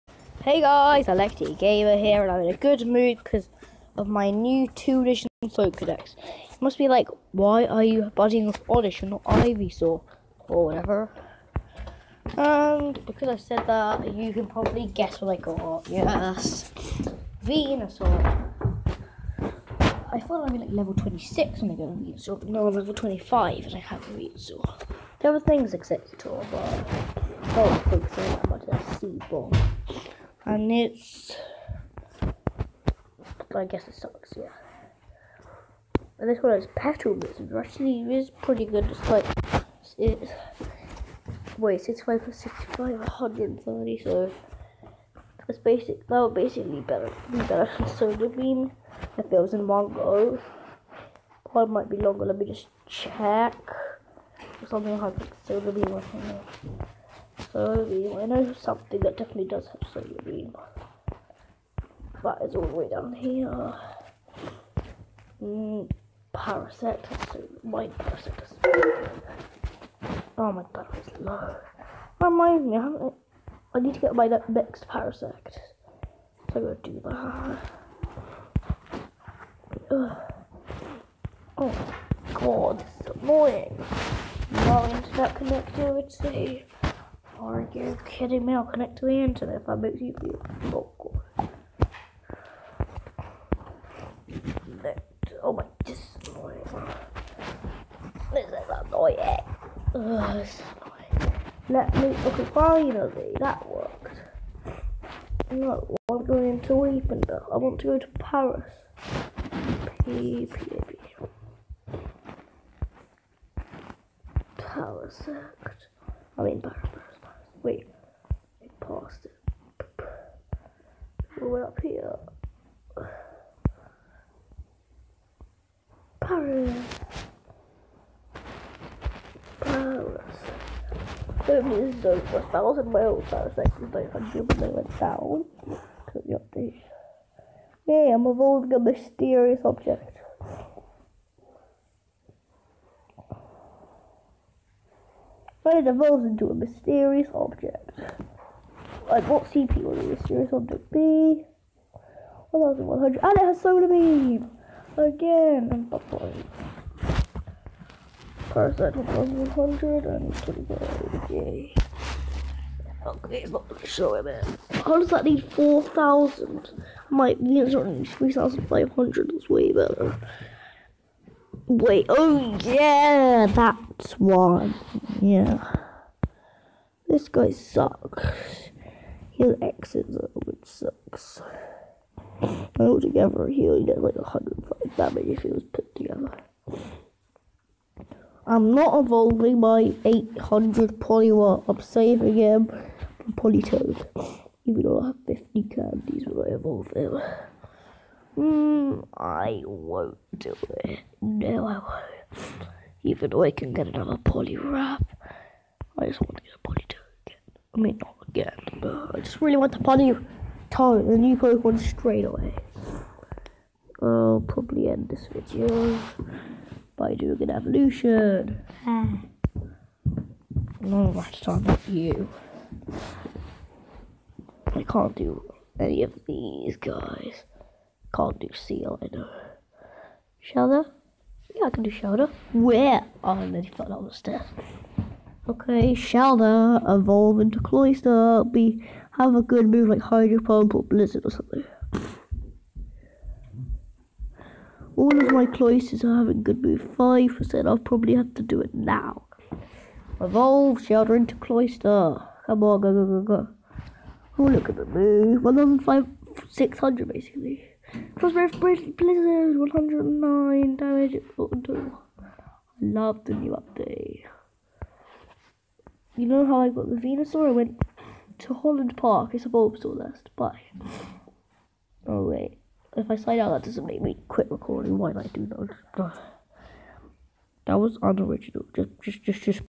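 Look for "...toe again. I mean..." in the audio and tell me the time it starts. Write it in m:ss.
3:26.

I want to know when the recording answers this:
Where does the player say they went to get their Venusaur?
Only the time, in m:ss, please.
4:28.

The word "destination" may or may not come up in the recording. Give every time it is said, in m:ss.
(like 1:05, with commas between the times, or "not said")
not said.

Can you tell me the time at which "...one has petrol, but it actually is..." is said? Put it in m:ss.
0:36.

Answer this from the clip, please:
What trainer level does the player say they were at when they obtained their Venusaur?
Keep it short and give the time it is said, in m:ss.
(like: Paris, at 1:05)
25, at 0:22.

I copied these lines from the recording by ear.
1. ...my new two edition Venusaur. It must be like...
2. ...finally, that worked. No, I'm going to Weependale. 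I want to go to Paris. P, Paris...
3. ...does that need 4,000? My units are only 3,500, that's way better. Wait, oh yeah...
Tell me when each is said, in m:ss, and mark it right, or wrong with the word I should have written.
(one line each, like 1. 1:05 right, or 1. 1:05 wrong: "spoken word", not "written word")
1. 0:04 wrong: "Pokedex", not "Venusaur"
2. 1:42 right
3. 2:44 right.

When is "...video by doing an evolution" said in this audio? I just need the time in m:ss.
3:35.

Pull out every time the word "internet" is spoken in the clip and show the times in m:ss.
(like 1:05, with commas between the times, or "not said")
1:24, 1:29.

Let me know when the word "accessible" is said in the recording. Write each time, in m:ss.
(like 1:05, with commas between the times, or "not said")
not said.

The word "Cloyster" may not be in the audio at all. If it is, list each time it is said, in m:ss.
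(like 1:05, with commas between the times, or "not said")
3:57, 4:05, 4:11.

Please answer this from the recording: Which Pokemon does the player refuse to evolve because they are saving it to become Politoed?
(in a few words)
Poliwag.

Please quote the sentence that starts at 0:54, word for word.
Something like solar beam or Soybean.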